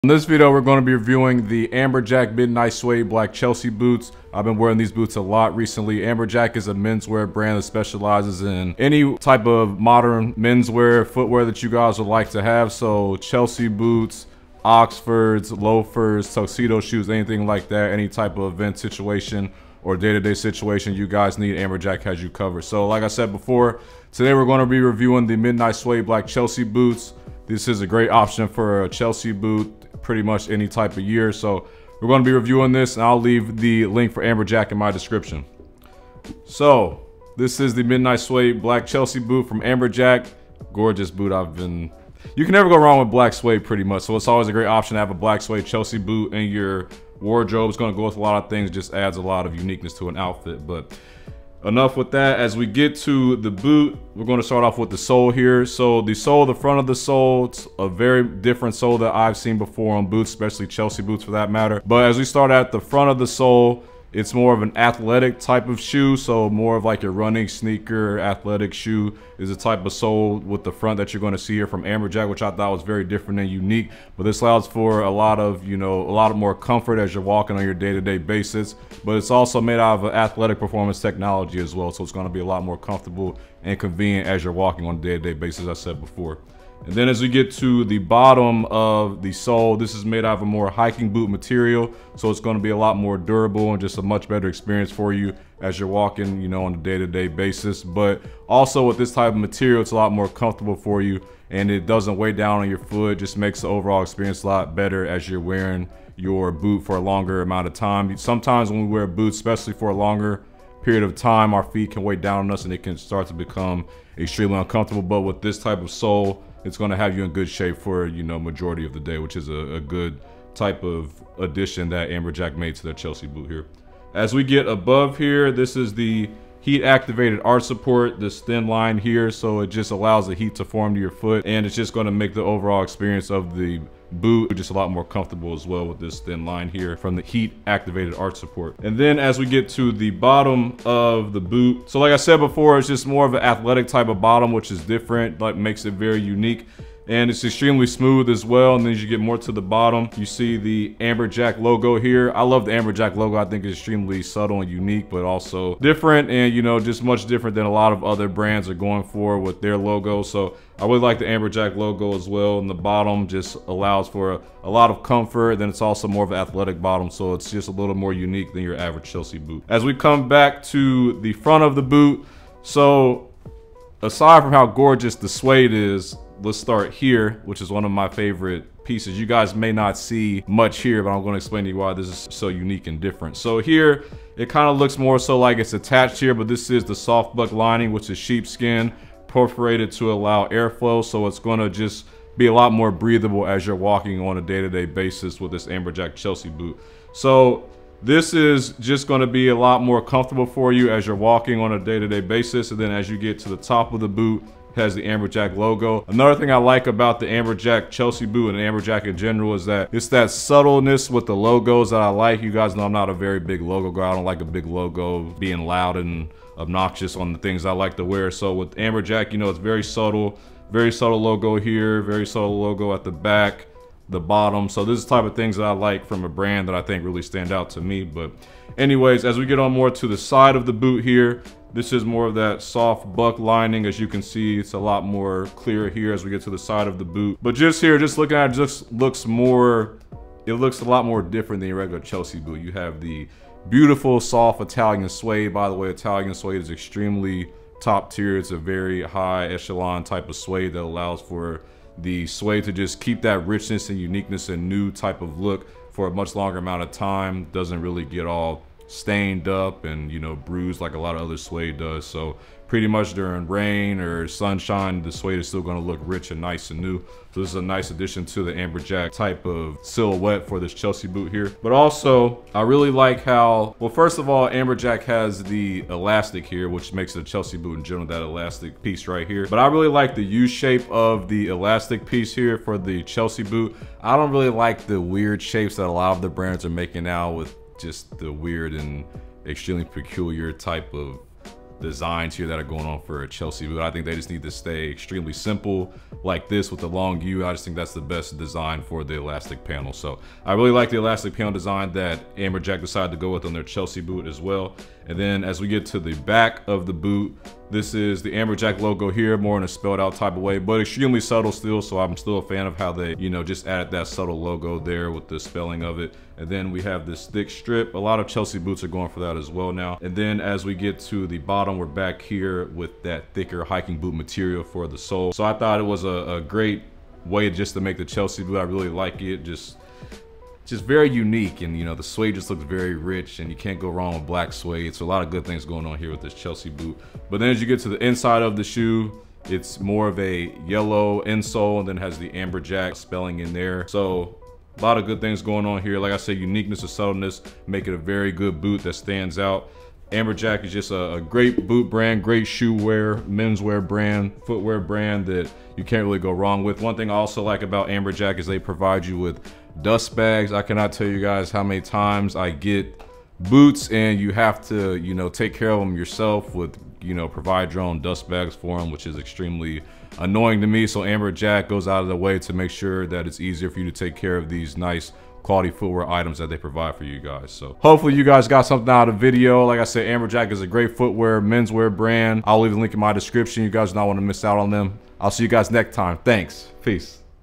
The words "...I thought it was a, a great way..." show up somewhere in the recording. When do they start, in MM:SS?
05:25.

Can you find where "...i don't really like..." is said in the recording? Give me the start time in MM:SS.
04:44.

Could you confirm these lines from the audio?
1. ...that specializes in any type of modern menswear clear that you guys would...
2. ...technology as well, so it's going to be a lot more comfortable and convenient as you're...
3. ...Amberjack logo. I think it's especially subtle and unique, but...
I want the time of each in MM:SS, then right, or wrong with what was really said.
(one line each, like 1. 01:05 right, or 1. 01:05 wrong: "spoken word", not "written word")
1. 00:07 wrong: "footwear", not "clear"
2. 01:20 right
3. 02:32 wrong: "extremely", not "especially".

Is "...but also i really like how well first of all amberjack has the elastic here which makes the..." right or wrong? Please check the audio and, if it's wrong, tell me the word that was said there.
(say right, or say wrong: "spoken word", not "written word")
right.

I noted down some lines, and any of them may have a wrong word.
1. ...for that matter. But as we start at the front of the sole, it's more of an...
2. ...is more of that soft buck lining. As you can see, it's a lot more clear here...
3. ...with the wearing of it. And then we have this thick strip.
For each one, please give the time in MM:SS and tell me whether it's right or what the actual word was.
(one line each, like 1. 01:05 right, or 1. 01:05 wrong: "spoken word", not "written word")
1. 01:01 right
2. 03:51 right
3. 05:15 wrong: "spelling", not "wearing".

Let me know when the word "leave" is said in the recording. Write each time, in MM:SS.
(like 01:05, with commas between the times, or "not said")
00:33, 06:22.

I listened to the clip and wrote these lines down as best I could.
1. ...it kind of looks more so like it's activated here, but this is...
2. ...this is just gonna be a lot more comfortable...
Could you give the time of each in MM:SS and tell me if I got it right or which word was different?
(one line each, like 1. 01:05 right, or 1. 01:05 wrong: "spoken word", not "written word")
1. 03:04 wrong: "attached", not "activated"
2. 03:18 right.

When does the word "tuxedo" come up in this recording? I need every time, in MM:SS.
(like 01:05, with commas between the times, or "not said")
00:16.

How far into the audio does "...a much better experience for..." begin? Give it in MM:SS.
01:33.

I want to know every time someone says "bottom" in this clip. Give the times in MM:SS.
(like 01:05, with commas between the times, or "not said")
01:27, 02:20, 02:24, 02:29, 02:42, 02:46, 03:44, 05:21.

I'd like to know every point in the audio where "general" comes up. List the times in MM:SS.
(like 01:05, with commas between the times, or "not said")
03:29, 04:37.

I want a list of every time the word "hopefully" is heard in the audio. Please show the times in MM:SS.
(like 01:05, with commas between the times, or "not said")
06:17.